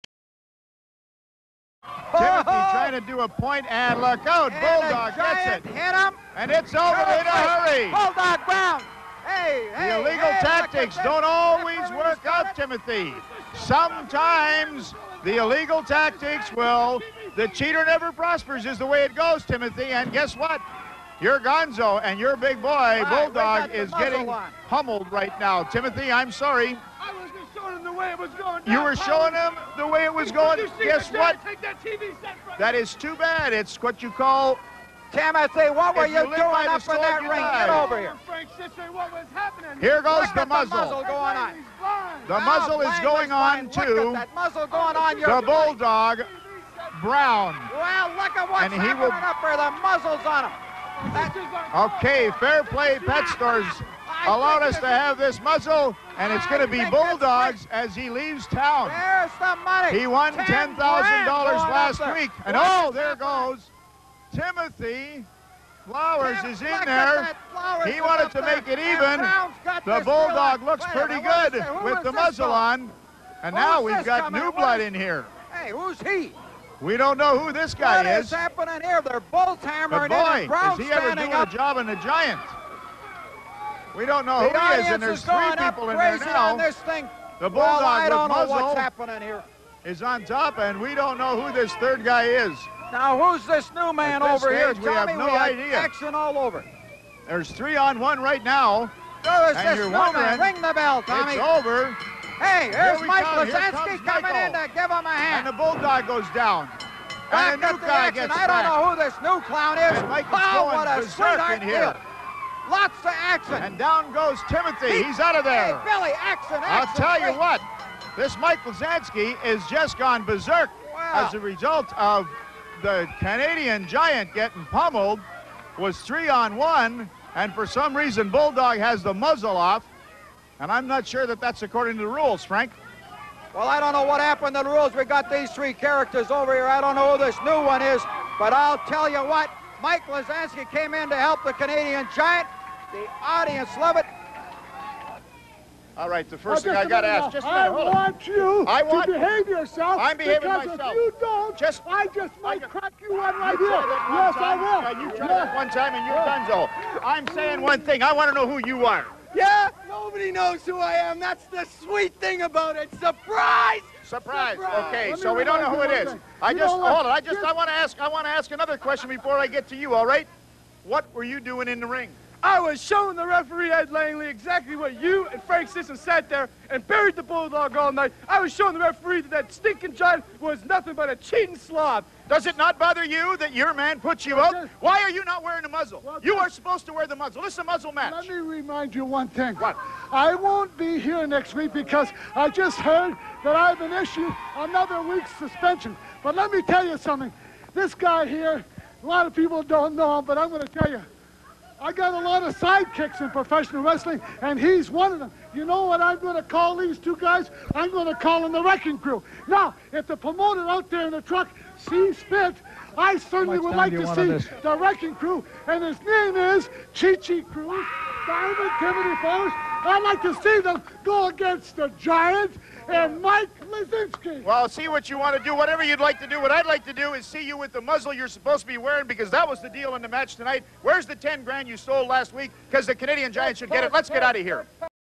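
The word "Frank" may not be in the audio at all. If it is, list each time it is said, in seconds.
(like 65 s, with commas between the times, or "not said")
38 s, 132 s, 175 s.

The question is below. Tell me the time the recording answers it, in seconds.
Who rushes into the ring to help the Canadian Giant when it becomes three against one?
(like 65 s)
103 s.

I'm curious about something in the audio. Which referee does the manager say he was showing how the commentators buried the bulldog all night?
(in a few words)
Ed Langley.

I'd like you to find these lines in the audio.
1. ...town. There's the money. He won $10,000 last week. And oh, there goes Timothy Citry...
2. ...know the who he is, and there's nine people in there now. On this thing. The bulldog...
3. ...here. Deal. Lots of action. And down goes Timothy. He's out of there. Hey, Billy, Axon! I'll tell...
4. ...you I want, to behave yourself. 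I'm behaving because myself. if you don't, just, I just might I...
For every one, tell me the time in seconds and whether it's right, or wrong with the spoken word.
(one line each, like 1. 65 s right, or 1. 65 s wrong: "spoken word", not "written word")
1. 58 s wrong: "Flowers", not "Citry"
2. 84 s wrong: "three", not "nine"
3. 111 s right
4. 148 s right.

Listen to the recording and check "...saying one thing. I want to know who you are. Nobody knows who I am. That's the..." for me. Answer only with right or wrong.
right.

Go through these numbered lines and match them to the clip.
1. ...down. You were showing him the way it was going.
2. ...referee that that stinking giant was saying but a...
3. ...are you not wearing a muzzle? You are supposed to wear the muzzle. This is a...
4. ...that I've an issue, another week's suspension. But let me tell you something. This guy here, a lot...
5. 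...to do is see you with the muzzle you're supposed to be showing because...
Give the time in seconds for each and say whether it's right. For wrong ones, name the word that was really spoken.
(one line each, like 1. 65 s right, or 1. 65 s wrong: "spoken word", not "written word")
1. 28 s right
2. 178 s wrong: "nothing", not "saying"
3. 185 s right
4. 193 s right
5. 226 s wrong: "wearing", not "showing".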